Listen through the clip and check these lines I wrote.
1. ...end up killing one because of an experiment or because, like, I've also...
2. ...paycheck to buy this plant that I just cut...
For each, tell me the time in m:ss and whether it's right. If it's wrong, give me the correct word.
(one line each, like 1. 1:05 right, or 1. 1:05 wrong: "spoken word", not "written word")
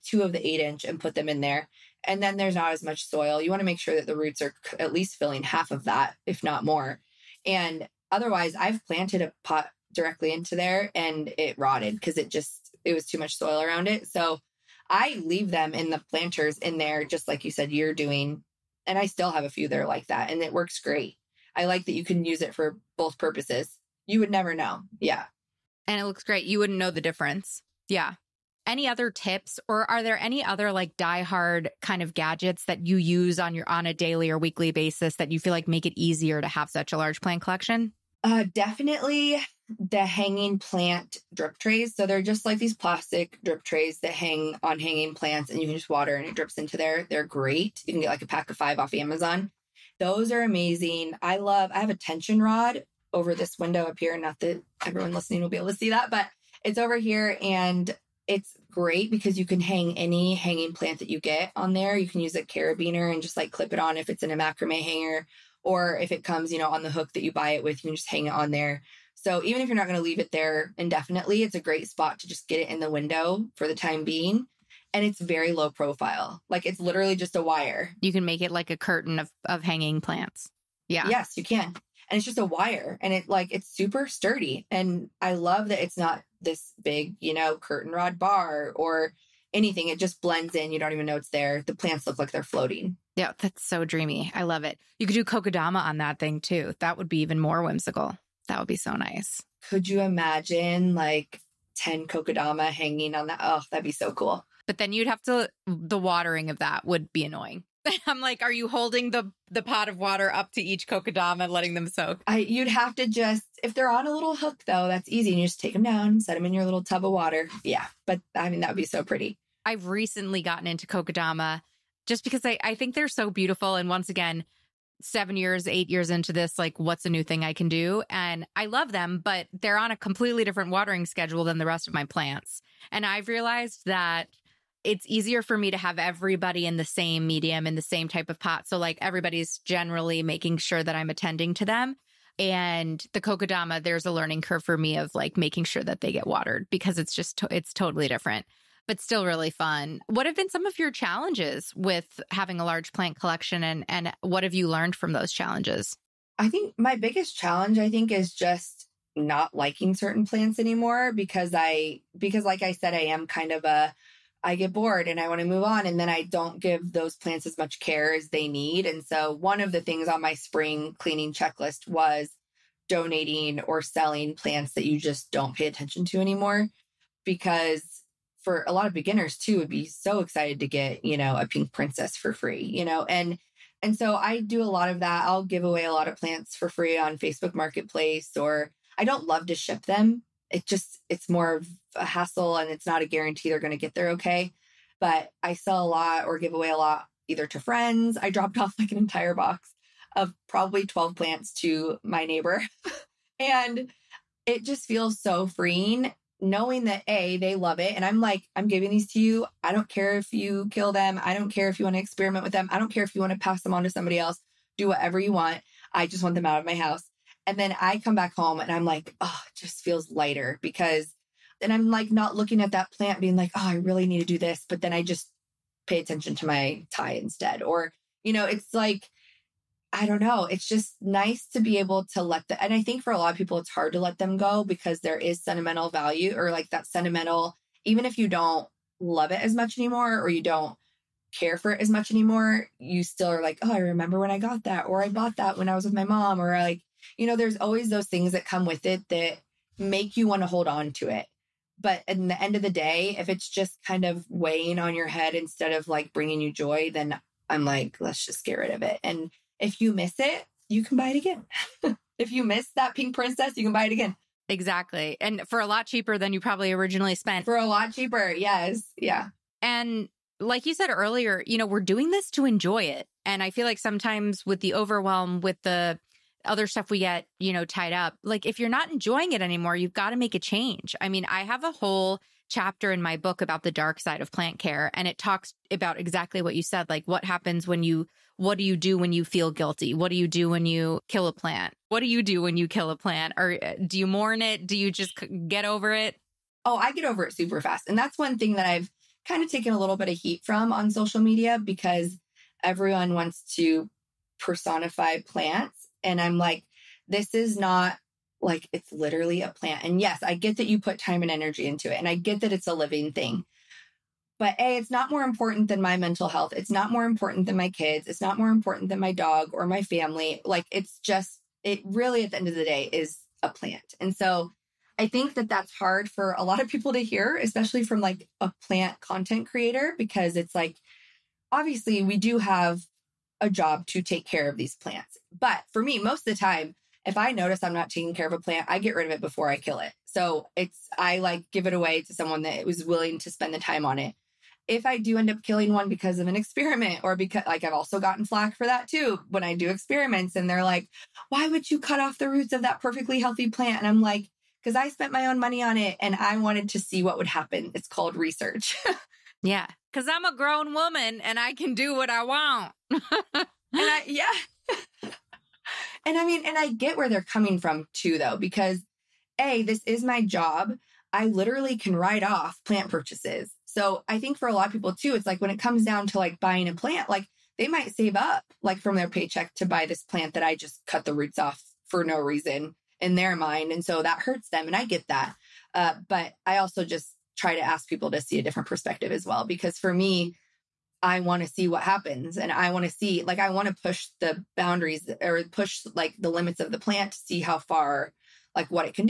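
1. 5:45 right
2. 6:19 right.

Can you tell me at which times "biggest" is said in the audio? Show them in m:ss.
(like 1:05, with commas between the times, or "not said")
2:36.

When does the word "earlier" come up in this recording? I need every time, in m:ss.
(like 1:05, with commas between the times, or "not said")
4:30.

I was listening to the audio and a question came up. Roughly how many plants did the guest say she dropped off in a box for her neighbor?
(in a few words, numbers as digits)
12.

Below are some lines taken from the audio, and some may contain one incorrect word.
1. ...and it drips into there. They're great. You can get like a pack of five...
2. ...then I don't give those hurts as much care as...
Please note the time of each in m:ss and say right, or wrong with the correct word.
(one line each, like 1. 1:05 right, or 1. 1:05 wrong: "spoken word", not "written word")
1. 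0:46 right
2. 2:45 wrong: "plants", not "hurts".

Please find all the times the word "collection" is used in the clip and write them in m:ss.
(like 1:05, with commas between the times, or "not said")
0:37, 2:33.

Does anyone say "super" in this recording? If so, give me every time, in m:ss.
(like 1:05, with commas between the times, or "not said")
1:23, 4:57.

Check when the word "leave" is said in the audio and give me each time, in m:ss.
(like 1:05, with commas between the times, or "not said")
0:15, 1:10.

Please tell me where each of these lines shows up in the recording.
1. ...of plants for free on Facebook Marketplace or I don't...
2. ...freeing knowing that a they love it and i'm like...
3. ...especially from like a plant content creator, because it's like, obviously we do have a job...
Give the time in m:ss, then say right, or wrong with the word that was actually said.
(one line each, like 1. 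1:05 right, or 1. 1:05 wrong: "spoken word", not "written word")
1. 3:06 right
2. 3:25 right
3. 5:27 right.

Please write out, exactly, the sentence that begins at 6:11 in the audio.
I literally can write off plant purchases.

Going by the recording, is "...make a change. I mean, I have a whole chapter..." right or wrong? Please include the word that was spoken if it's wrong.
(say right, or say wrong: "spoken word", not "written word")
right.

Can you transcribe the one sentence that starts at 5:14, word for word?
But A, it's not more important than my mental health.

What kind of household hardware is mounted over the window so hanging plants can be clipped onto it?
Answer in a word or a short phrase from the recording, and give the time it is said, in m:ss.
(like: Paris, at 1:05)
Tension rod, at 0:51.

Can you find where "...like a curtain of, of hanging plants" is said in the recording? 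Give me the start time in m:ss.
1:18.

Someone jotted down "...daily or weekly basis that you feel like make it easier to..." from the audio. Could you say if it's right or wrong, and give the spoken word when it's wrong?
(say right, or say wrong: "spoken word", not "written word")
right.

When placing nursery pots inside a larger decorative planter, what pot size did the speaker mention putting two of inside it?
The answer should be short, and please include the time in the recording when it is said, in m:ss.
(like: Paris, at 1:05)
8 inch, at 0:00.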